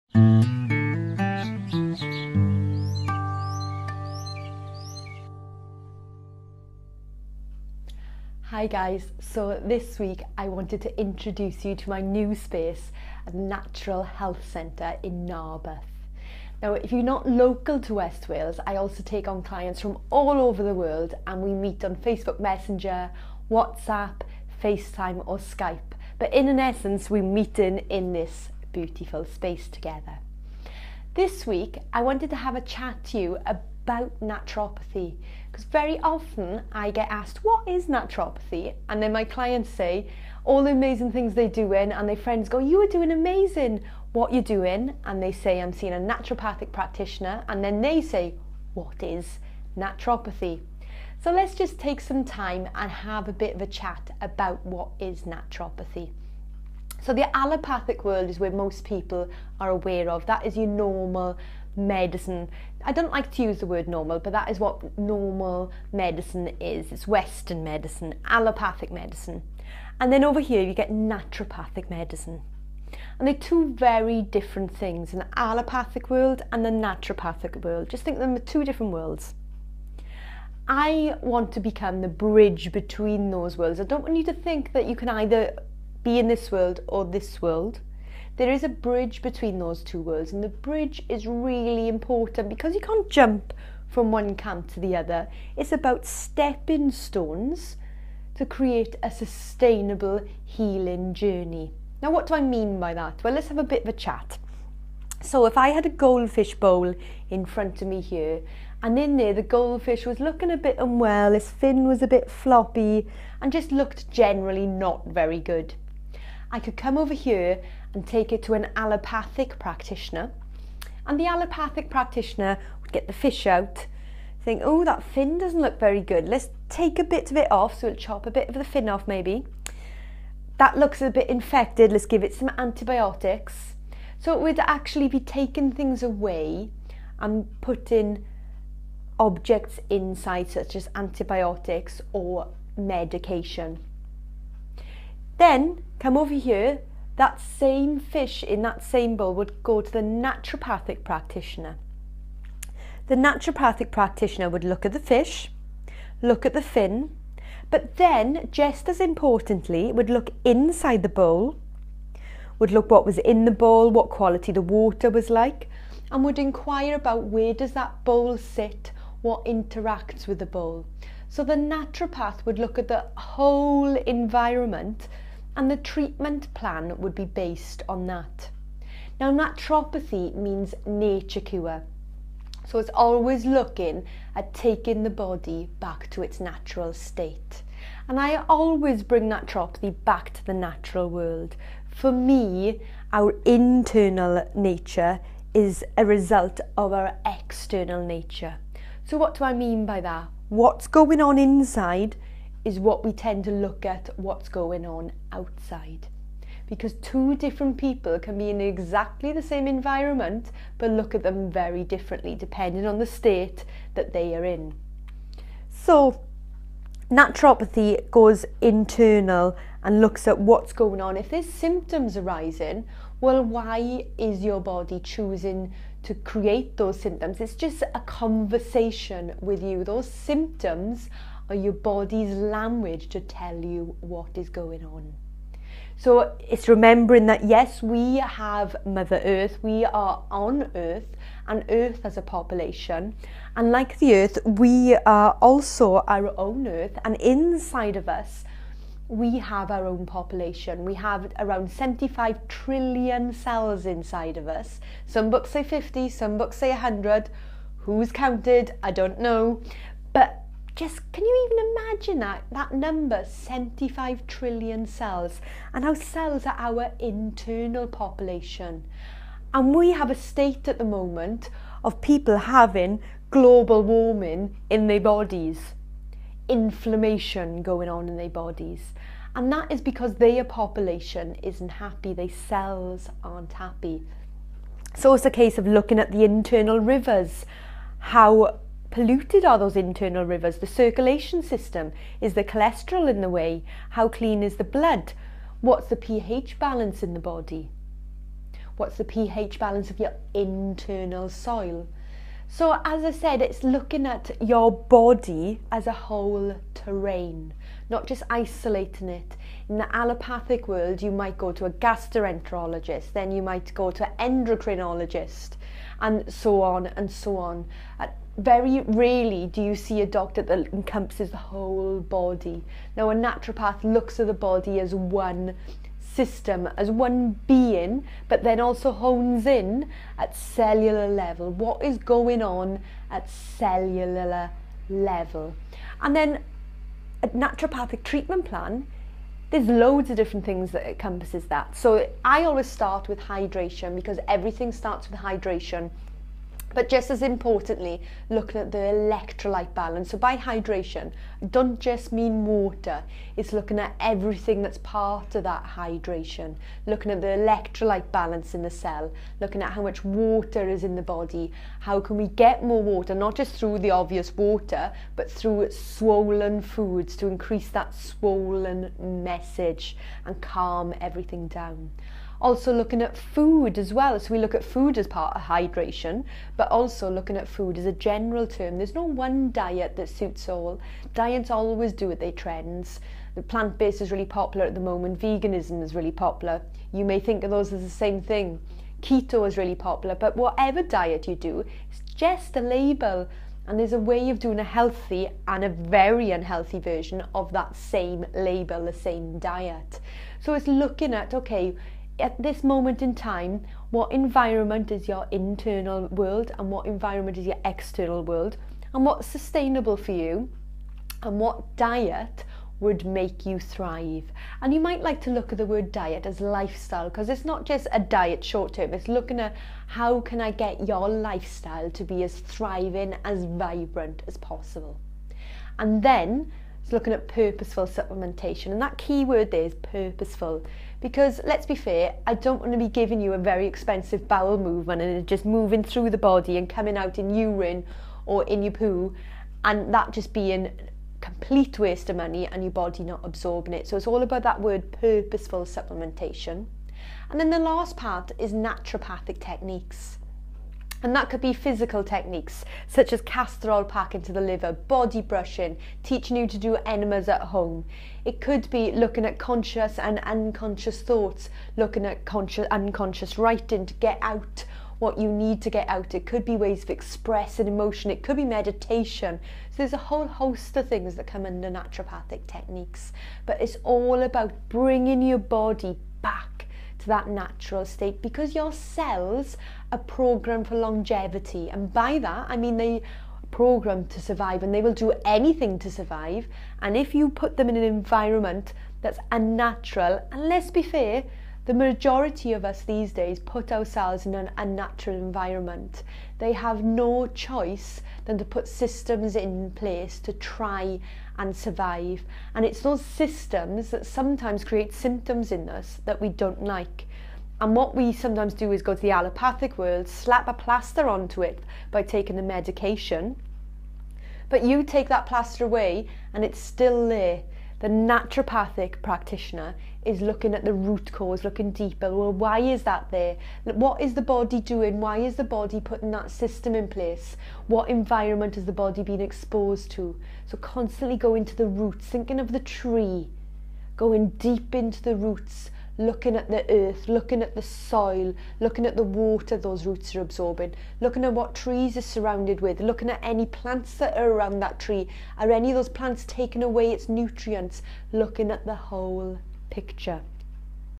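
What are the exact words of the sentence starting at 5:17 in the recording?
At uh, Very rarely do you see a doctor that encompasses the whole body.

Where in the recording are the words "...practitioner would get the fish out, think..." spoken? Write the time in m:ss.
2:01.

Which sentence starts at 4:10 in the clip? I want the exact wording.
We have around 75 trillion cells inside of us.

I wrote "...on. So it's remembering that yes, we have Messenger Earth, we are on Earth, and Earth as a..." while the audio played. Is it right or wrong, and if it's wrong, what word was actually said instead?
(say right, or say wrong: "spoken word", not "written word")
wrong: "Mother", not "Messenger".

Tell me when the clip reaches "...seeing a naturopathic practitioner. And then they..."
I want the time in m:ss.
0:45.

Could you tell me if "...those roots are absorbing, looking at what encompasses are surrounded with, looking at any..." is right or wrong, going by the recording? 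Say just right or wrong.
wrong.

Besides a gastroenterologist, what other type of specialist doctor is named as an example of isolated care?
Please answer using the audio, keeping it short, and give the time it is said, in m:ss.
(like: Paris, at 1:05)
Endocrinologist, at 5:14.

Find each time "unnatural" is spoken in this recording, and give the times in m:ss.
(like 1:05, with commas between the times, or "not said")
8:09, 8:14.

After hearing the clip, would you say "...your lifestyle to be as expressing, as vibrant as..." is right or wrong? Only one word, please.
wrong.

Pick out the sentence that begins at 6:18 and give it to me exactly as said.
There's no one diet that suits all.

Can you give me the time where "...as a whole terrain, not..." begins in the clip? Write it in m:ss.
5:05.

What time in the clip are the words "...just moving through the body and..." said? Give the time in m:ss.
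7:15.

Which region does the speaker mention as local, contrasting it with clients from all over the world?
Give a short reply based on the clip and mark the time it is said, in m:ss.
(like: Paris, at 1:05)
West Wales, at 0:17.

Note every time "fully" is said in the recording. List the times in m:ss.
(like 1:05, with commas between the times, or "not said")
not said.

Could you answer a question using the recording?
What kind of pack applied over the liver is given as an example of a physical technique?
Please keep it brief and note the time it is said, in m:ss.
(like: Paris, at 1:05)
Castor pack, at 7:33.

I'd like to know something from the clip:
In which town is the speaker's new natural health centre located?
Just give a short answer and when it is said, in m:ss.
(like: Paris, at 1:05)
Narberth, at 0:15.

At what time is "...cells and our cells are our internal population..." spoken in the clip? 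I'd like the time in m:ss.
4:24.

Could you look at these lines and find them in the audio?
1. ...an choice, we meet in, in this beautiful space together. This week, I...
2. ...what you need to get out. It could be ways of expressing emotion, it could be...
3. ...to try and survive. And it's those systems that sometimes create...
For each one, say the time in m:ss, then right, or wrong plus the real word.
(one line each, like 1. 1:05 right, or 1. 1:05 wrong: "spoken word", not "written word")
1. 0:26 wrong: "essence", not "choice"
2. 7:44 right
3. 8:20 right.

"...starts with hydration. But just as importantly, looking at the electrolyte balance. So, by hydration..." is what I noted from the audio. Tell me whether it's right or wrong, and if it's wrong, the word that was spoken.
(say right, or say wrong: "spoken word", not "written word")
right.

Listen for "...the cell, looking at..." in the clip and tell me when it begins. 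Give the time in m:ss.
5:58.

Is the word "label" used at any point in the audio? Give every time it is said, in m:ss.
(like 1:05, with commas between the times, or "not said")
6:32, 6:38.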